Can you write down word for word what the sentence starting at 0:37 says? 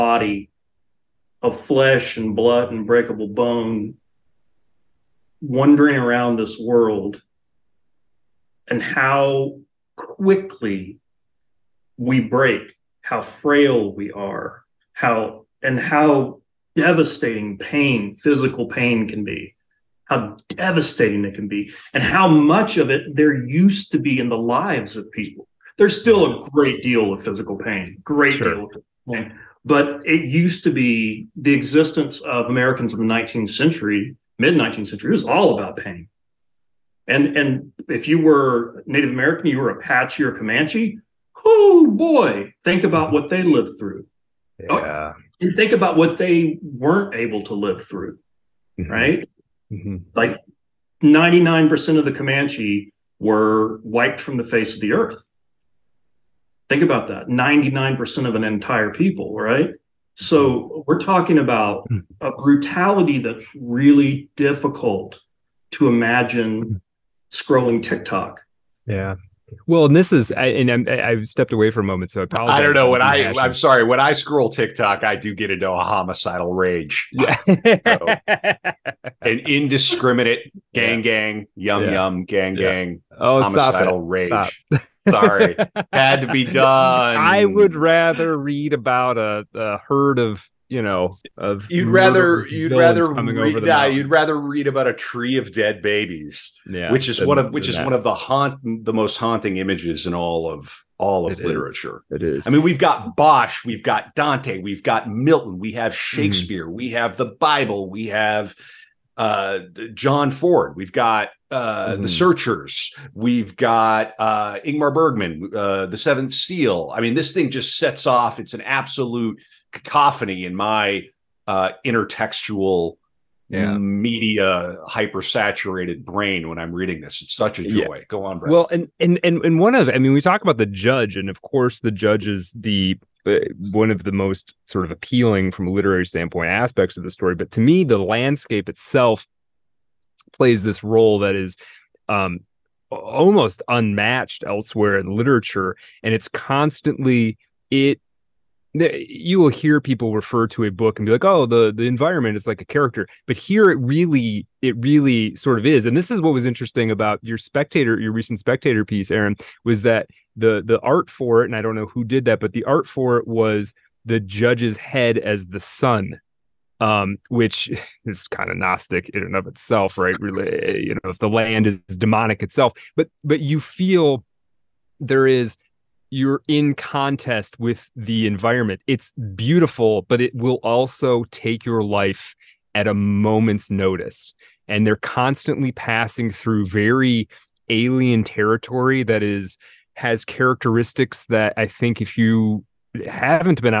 And, and if you were Native American, you were Apache or Comanche, oh boy, think about what they lived through Oh, yeah.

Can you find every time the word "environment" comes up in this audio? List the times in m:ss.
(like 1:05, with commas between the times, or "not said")
2:31, 2:58.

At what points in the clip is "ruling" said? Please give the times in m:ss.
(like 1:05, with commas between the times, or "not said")
not said.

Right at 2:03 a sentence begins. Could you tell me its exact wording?
media hypersaturated brain when I'm reading this.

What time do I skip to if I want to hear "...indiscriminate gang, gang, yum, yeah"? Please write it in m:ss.
1:19.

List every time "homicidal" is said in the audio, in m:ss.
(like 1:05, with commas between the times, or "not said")
1:15, 1:23.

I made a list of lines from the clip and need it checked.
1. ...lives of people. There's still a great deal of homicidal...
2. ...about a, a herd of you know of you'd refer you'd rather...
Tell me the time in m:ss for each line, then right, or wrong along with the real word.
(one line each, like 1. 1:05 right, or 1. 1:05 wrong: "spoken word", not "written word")
1. 0:24 wrong: "physical", not "homicidal"
2. 1:28 wrong: "rather", not "refer".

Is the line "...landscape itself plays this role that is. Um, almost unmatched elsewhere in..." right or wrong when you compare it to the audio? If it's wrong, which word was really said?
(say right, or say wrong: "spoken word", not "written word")
right.